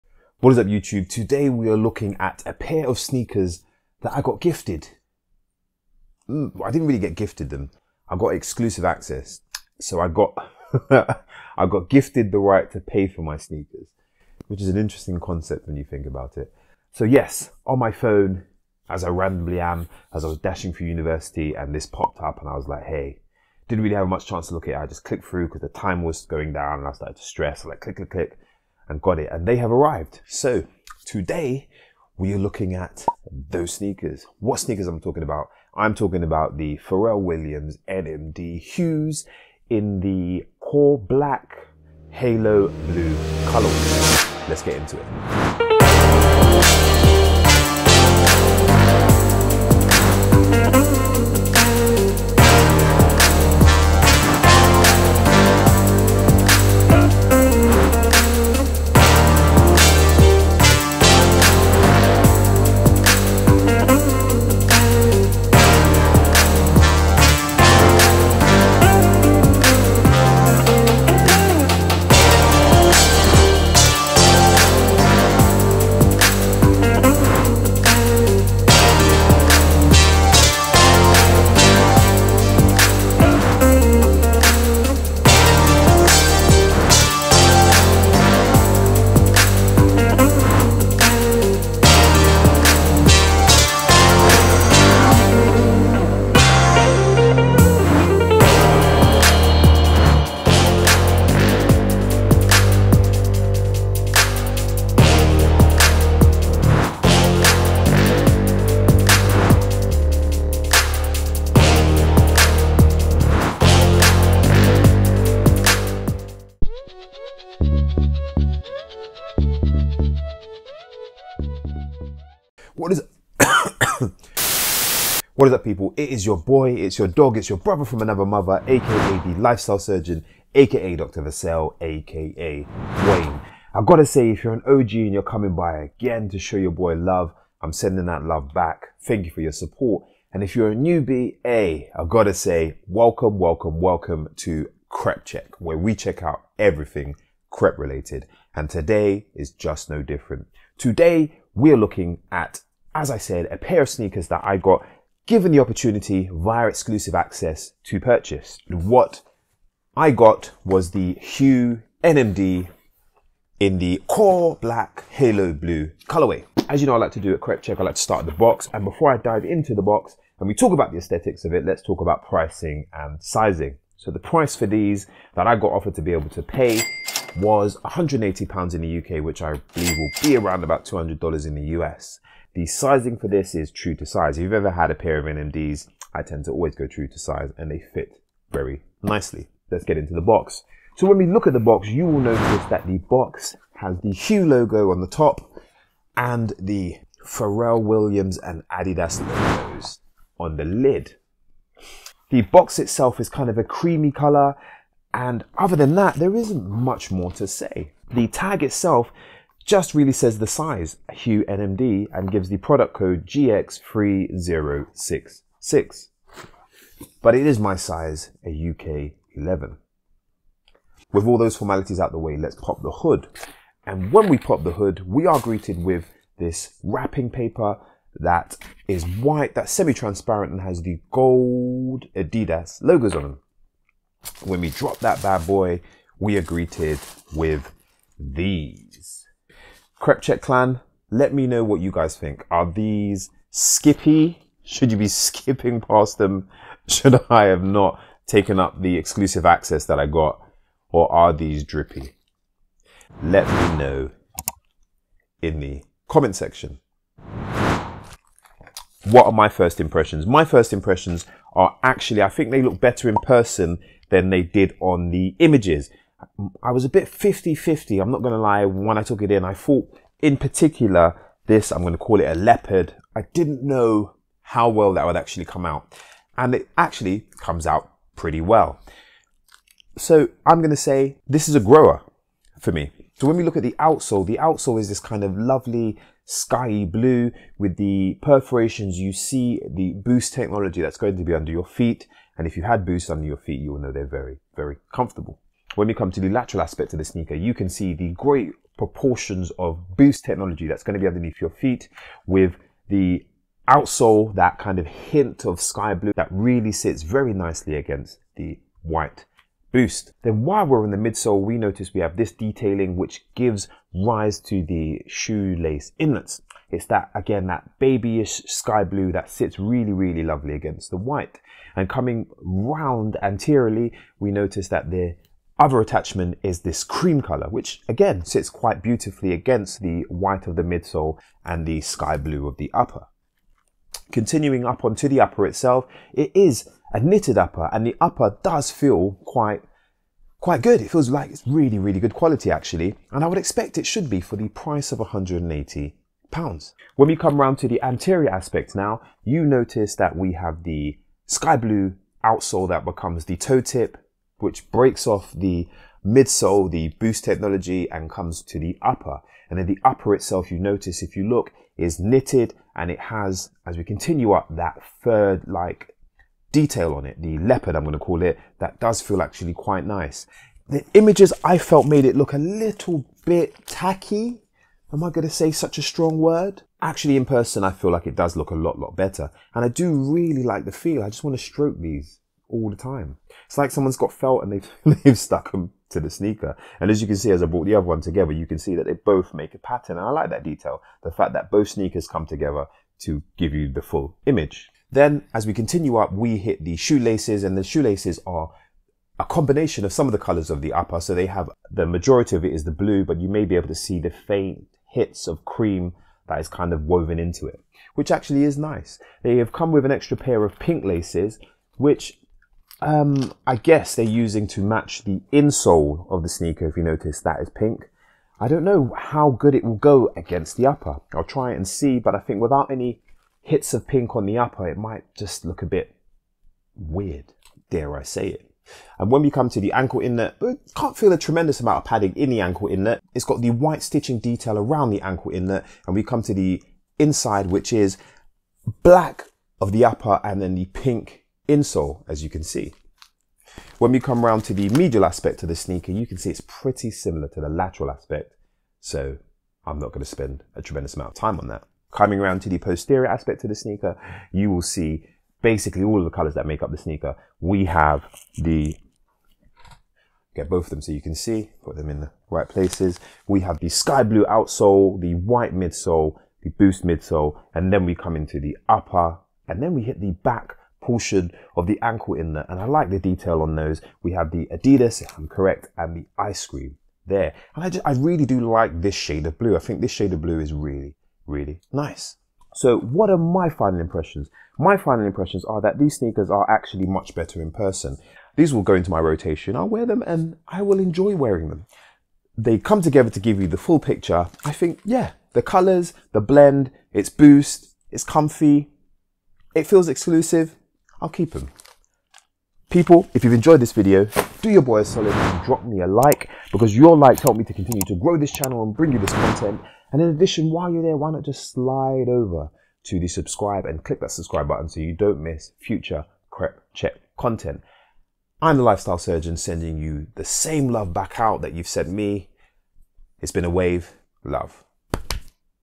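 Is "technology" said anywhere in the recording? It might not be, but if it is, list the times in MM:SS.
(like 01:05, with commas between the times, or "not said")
04:50, 05:00, 05:57.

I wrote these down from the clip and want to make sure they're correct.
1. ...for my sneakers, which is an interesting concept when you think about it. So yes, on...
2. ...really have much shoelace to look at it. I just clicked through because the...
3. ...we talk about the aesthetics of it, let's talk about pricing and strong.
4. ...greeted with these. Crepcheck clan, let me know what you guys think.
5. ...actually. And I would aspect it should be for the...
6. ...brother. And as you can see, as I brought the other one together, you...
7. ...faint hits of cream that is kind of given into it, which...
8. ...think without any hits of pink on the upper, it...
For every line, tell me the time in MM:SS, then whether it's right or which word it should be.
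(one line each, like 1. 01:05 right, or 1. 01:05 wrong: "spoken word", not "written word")
1. 00:13 right
2. 00:23 wrong: "chance", not "shoelace"
3. 02:50 wrong: "sizing", not "strong"
4. 03:56 right
5. 05:42 wrong: "expect", not "aspect"
6. 06:26 wrong: "sneaker", not "brother"
7. 06:44 wrong: "woven", not "given"
8. 07:02 right.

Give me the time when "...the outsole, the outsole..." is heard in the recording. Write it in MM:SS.
04:43.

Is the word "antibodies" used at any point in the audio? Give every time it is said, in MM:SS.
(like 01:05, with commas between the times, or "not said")
not said.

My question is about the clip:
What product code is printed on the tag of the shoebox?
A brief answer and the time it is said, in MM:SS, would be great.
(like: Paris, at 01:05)
GX3066, at 03:33.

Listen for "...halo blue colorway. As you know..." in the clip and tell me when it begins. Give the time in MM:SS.
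02:45.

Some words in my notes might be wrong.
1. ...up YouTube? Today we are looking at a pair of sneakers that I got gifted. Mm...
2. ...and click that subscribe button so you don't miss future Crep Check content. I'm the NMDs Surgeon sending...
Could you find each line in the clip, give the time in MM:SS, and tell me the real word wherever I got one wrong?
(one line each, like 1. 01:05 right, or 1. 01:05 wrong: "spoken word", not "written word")
1. 00:00 right
2. 08:33 wrong: "Lifestyle", not "NMDs".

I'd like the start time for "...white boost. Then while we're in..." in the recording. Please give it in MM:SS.
05:08.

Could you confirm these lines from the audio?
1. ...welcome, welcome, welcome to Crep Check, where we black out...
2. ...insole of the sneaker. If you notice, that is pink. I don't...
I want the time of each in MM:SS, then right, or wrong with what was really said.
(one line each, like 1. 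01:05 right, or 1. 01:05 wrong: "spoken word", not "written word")
1. 02:22 wrong: "check", not "black"
2. 06:55 right.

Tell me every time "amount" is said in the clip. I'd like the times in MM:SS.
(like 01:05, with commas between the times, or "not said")
07:11, 07:30.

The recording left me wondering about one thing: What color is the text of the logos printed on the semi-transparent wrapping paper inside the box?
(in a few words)
Gold.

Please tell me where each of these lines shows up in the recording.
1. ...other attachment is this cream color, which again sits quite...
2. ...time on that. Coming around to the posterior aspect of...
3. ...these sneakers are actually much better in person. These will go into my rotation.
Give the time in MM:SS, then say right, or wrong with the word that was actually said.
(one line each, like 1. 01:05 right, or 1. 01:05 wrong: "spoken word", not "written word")
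1. 05:25 right
2. 07:31 right
3. 08:05 right.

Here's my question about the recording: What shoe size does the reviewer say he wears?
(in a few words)
UK 11.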